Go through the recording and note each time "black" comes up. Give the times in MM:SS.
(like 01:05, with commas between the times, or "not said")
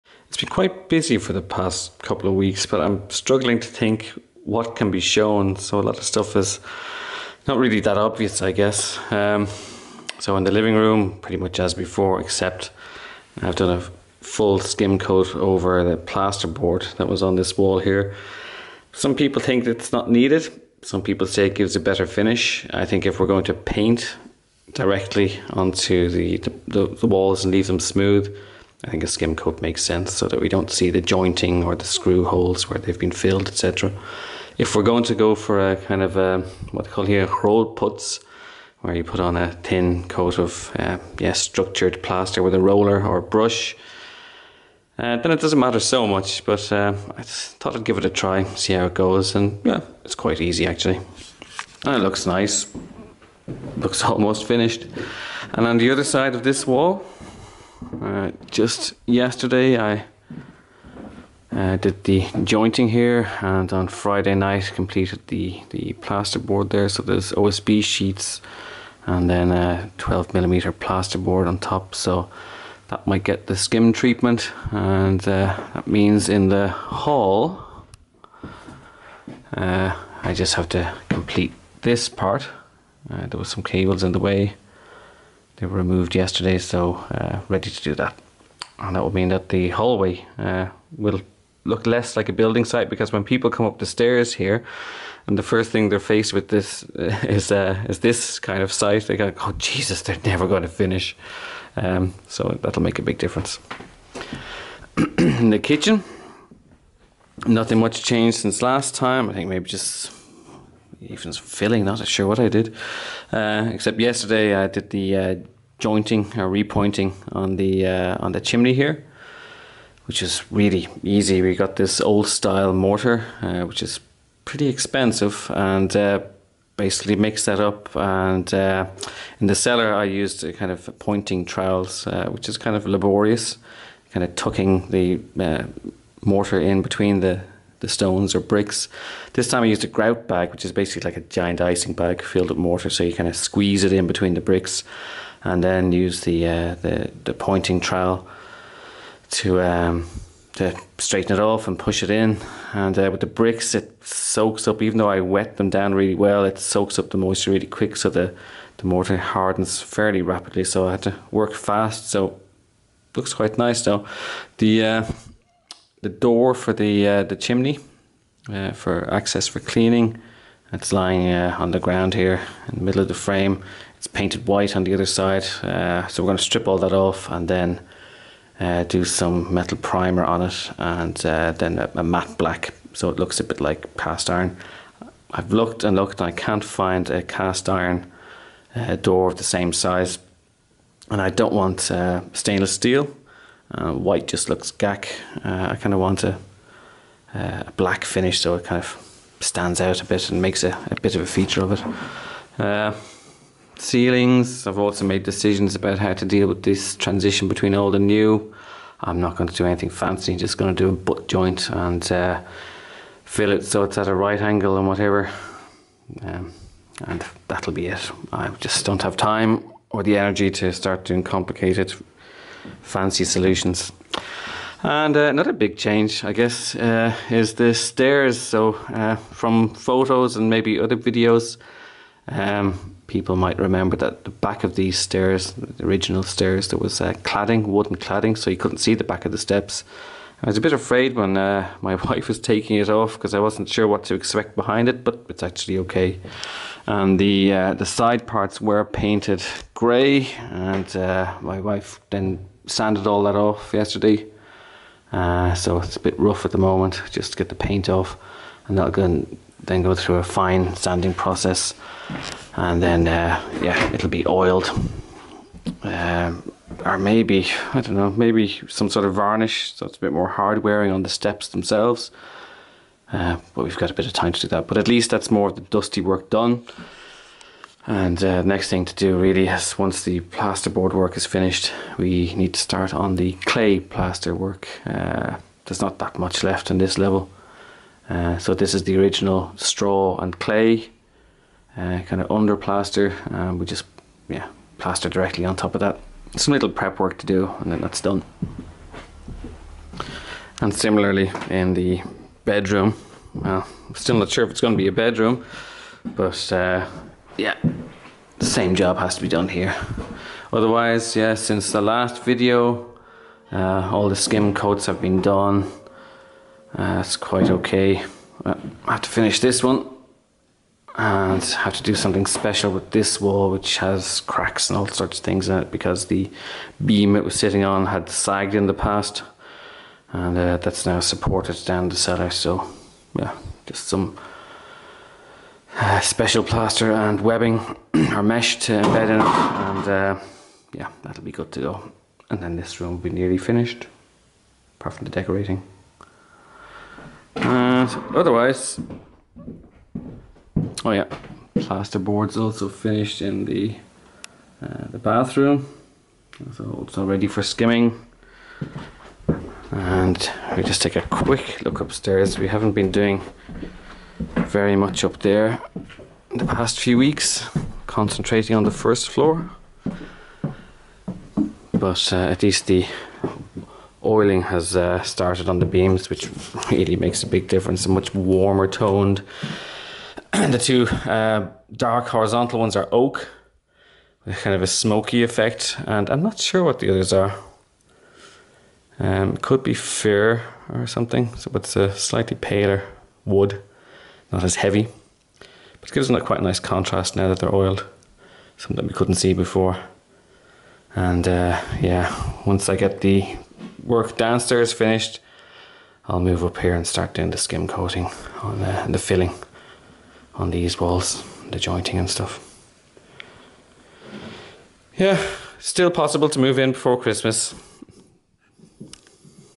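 03:02, 03:17.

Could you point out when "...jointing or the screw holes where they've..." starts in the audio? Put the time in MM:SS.
00:31.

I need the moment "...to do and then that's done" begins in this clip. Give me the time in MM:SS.
04:57.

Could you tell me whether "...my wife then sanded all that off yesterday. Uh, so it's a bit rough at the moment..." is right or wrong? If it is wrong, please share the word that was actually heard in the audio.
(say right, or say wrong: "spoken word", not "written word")
right.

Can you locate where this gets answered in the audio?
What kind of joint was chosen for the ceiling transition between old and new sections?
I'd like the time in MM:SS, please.
03:30.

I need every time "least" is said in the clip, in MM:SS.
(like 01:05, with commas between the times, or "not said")
04:34, 06:12.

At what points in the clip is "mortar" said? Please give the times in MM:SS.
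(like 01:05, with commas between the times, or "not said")
02:02, 02:16, 02:22, 02:38.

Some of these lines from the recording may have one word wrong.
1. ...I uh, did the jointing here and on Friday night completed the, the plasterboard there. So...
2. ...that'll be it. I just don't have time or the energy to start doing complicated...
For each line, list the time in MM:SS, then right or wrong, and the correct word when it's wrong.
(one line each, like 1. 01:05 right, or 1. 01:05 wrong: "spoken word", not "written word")
1. 00:59 right
2. 03:37 right.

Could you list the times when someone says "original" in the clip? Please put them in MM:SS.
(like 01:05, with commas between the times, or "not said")
03:55, 04:48.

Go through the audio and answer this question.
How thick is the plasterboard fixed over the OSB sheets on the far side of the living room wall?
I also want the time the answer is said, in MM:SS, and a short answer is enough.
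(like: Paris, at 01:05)
12 millimeter, at 01:09.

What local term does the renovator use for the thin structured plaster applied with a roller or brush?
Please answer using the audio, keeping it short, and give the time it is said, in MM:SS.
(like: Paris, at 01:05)
Rollputz, at 00:37.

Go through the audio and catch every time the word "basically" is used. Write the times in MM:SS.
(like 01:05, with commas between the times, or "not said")
02:06, 02:20.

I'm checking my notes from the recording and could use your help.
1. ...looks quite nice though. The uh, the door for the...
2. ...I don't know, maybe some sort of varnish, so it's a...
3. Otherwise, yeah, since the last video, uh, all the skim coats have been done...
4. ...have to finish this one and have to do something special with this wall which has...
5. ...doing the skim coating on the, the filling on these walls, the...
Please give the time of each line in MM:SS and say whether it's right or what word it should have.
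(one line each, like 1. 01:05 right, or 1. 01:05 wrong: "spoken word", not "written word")
1. 02:43 right
2. 04:27 right
3. 05:10 right
4. 05:18 right
5. 06:47 right.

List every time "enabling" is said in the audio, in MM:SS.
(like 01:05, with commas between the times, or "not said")
not said.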